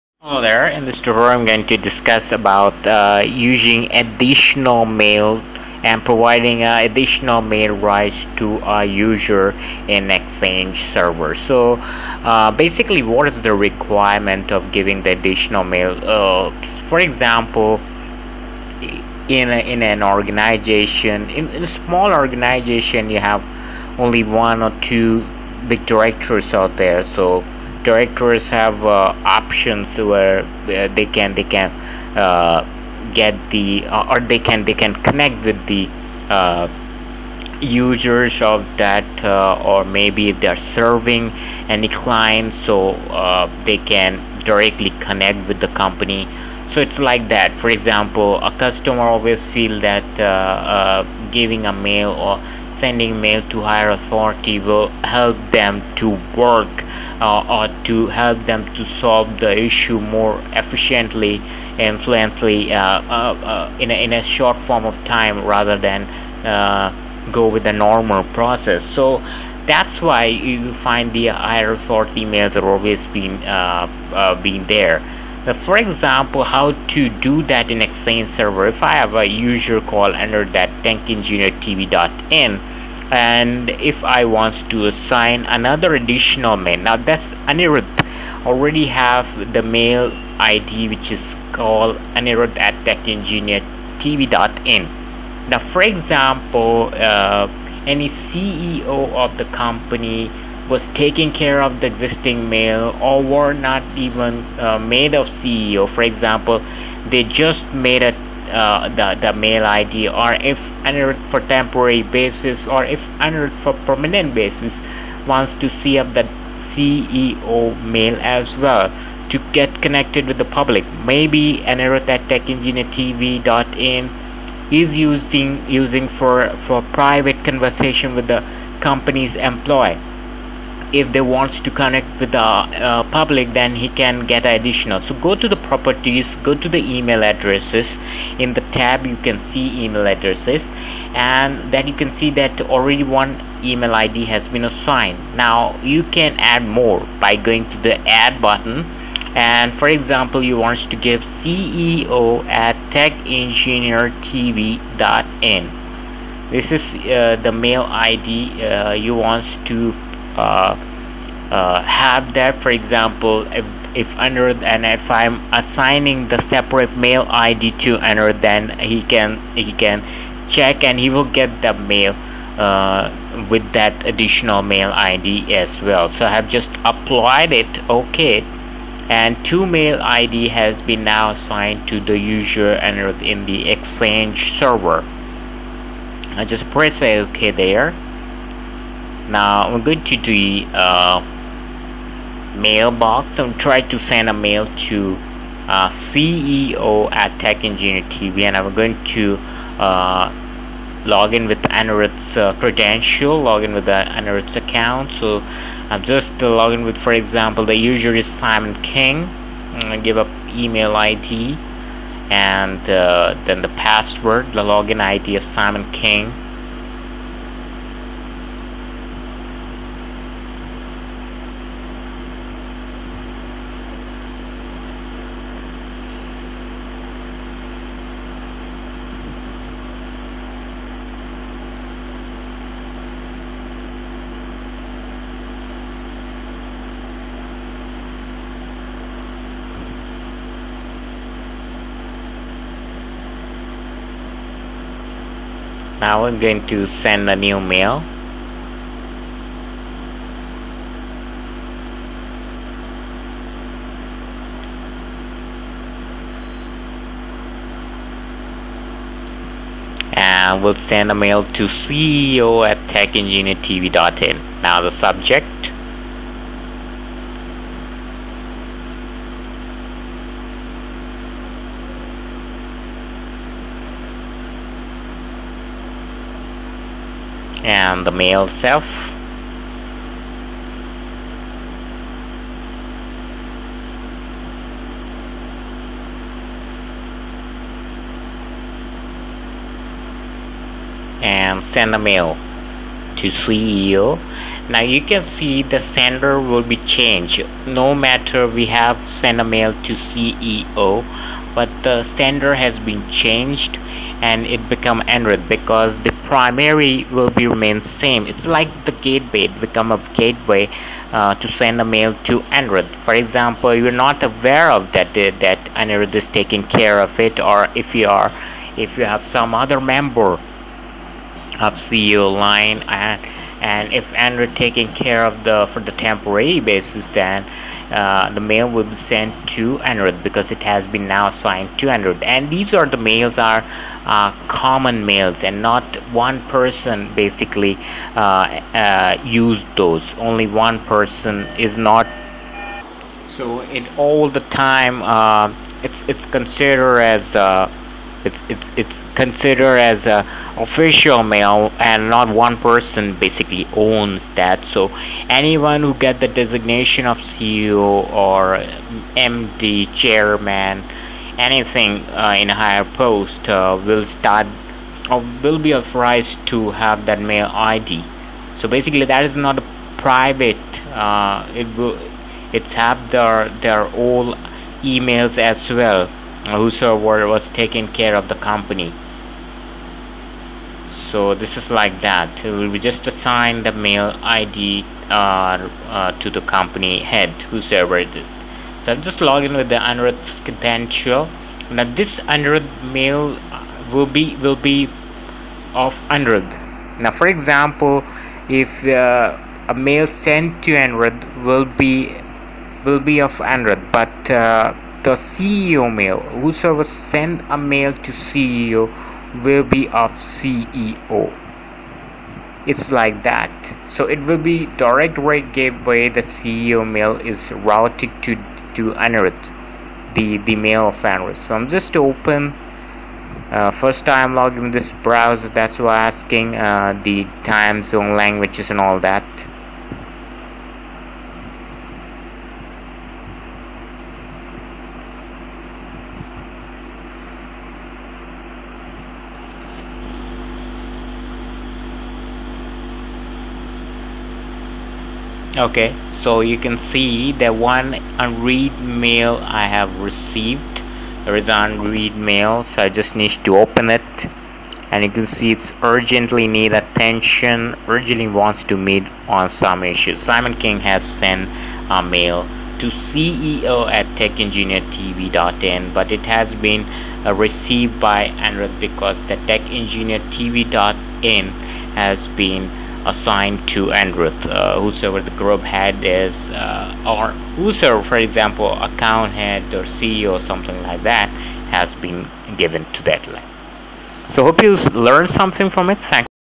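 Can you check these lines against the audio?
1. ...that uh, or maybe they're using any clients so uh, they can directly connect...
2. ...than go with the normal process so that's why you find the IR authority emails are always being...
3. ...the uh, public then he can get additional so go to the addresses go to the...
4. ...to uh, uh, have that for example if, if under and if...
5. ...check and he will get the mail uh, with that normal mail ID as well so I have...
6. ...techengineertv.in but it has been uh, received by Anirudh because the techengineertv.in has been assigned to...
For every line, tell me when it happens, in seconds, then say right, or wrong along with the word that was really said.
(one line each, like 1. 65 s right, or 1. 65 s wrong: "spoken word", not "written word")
1. 38 s wrong: "serving", not "using"
2. 65 s right
3. 132 s wrong: "properties", not "addresses"
4. 159 s right
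5. 170 s wrong: "additional", not "normal"
6. 464 s right.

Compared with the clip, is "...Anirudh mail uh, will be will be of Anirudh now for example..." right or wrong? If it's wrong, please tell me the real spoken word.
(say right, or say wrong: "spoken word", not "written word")
right.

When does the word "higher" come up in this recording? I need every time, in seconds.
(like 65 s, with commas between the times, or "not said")
53 s, 362 s.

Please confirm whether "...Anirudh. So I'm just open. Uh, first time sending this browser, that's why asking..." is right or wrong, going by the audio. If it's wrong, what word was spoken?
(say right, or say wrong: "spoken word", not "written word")
wrong: "logging", not "sending".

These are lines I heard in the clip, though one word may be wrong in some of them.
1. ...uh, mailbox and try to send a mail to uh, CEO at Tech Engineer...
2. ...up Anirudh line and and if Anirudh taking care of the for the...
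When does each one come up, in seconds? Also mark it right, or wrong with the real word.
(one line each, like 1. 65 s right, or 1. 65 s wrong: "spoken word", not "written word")
1. 190 s right
2. 321 s wrong: "CEO", not "Anirudh".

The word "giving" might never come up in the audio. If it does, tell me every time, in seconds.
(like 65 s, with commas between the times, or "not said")
14 s, 51 s.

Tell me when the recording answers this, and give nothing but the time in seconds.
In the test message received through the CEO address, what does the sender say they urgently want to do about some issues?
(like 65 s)
458 s.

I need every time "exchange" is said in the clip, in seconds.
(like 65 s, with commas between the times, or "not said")
10 s, 77 s, 183 s.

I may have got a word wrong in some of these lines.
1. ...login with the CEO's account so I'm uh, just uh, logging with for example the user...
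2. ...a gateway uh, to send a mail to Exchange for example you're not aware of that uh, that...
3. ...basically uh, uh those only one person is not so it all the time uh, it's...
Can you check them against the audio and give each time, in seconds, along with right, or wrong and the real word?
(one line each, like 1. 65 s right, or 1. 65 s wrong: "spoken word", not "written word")
1. 203 s wrong: "Anirudh", not "CEO"
2. 309 s wrong: "Anirudh", not "Exchange"
3. 337 s right.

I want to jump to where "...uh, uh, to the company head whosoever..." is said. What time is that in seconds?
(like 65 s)
385 s.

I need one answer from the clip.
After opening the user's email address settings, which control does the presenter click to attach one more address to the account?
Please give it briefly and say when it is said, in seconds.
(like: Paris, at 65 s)
Add button, at 148 s.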